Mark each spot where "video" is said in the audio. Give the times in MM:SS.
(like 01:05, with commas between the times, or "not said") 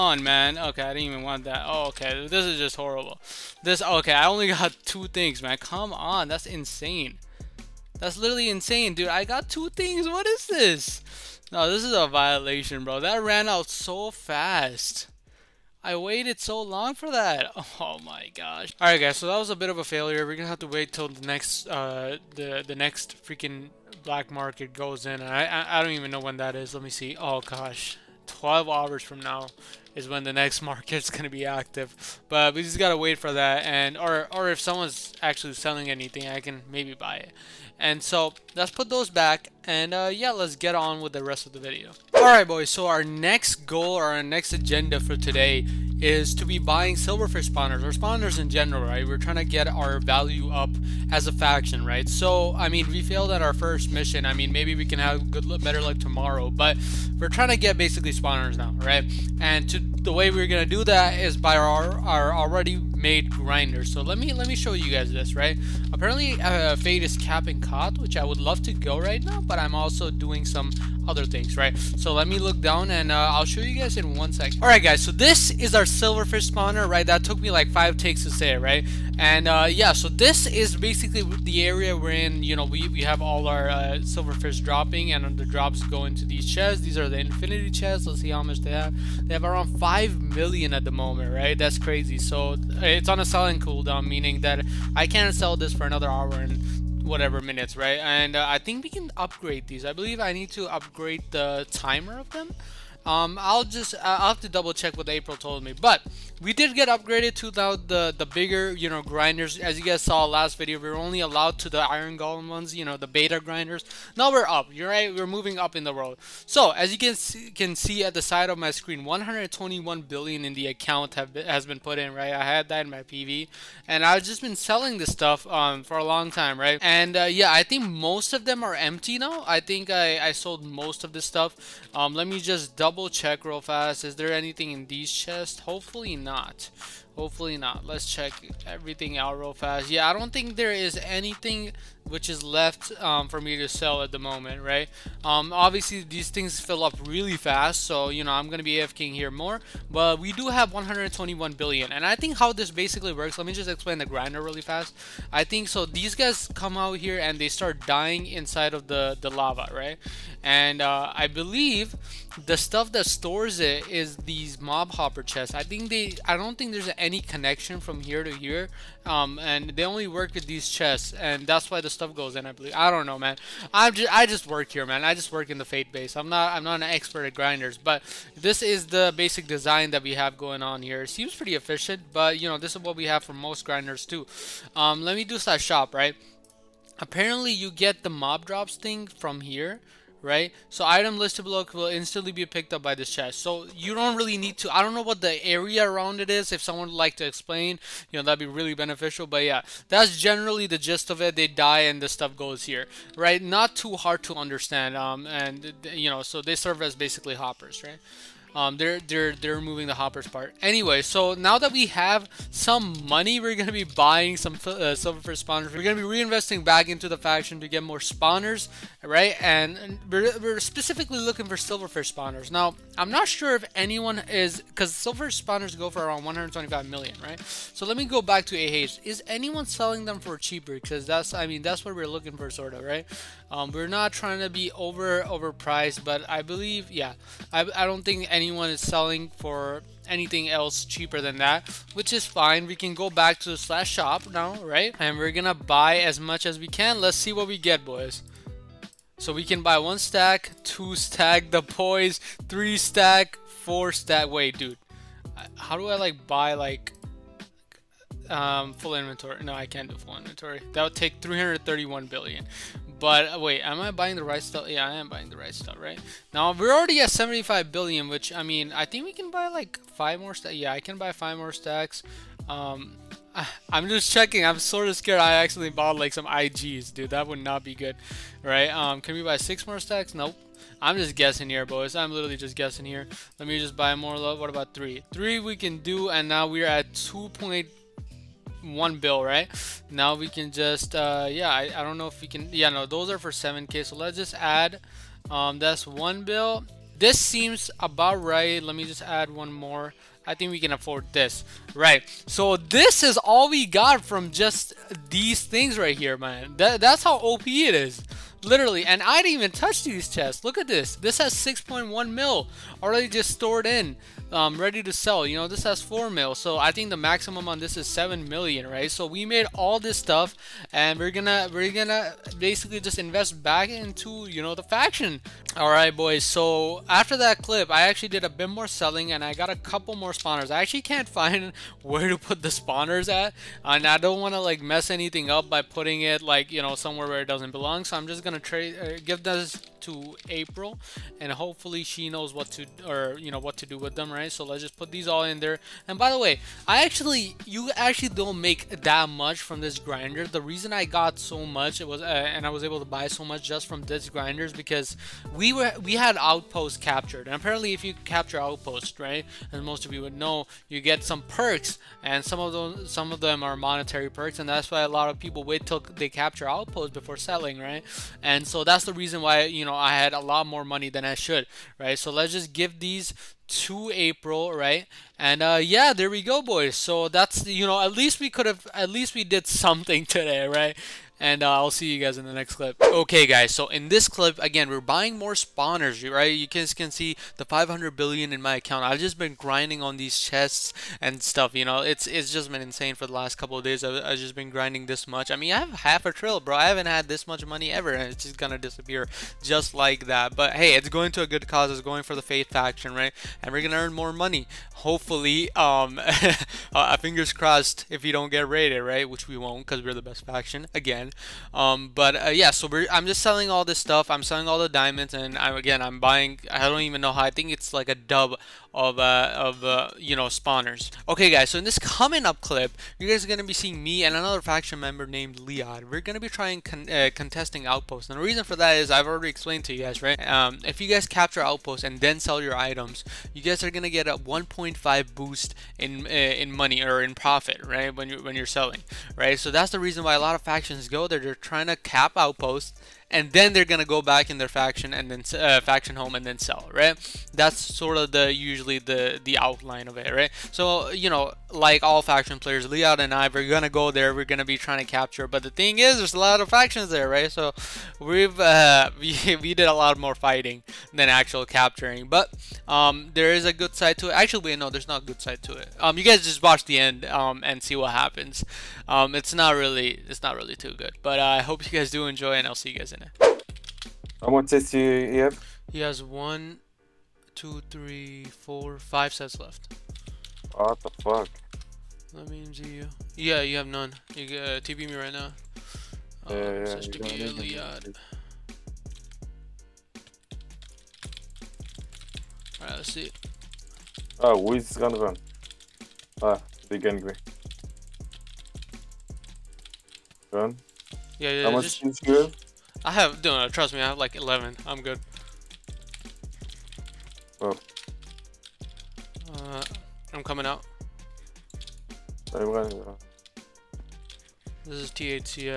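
00:41, 01:50.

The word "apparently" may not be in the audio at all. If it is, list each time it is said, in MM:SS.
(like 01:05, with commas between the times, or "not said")
01:05, 03:06, 05:57.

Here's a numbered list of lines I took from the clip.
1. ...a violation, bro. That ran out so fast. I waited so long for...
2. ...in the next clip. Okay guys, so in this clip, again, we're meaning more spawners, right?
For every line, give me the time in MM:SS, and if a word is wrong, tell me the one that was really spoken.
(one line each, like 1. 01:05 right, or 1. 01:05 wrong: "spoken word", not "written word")
1. 00:11 right
2. 06:22 wrong: "buying", not "meaning".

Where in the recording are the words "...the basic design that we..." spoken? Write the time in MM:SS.
02:58.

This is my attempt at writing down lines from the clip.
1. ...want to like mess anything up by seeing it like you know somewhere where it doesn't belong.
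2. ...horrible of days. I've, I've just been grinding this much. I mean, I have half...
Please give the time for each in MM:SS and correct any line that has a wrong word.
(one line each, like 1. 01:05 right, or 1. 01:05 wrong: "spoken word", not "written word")
1. 05:34 wrong: "putting", not "seeing"
2. 06:33 wrong: "couple", not "horrible".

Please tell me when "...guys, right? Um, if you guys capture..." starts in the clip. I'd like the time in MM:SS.
07:09.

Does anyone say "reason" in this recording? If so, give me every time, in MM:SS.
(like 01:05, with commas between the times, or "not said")
05:50, 06:08, 07:08, 07:19.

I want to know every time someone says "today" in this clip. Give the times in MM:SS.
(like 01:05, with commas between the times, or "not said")
00:45, 06:20.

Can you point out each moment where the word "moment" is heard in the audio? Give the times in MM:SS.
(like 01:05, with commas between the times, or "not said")
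01:30, 02:24.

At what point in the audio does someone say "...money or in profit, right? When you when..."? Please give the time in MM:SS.
07:16.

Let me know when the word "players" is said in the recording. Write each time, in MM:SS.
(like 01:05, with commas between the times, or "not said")
07:32.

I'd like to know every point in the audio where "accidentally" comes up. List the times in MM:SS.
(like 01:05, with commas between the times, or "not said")
04:35.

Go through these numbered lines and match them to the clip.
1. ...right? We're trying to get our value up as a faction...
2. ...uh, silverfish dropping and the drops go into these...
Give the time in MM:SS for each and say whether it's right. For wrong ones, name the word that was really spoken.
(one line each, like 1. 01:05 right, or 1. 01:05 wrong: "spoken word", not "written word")
1. 00:48 right
2. 01:23 right.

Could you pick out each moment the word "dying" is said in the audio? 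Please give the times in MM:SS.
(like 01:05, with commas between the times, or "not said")
02:37.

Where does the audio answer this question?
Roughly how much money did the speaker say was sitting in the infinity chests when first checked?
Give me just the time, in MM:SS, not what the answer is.
01:29.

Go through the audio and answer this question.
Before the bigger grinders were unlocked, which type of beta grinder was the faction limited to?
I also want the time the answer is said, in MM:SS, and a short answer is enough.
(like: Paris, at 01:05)
Iron Golem, at 01:51.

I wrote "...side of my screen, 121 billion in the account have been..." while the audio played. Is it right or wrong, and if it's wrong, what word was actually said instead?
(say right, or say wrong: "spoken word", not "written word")
right.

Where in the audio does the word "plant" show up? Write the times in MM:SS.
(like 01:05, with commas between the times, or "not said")
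not said.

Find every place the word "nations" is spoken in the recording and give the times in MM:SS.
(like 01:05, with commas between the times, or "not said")
not said.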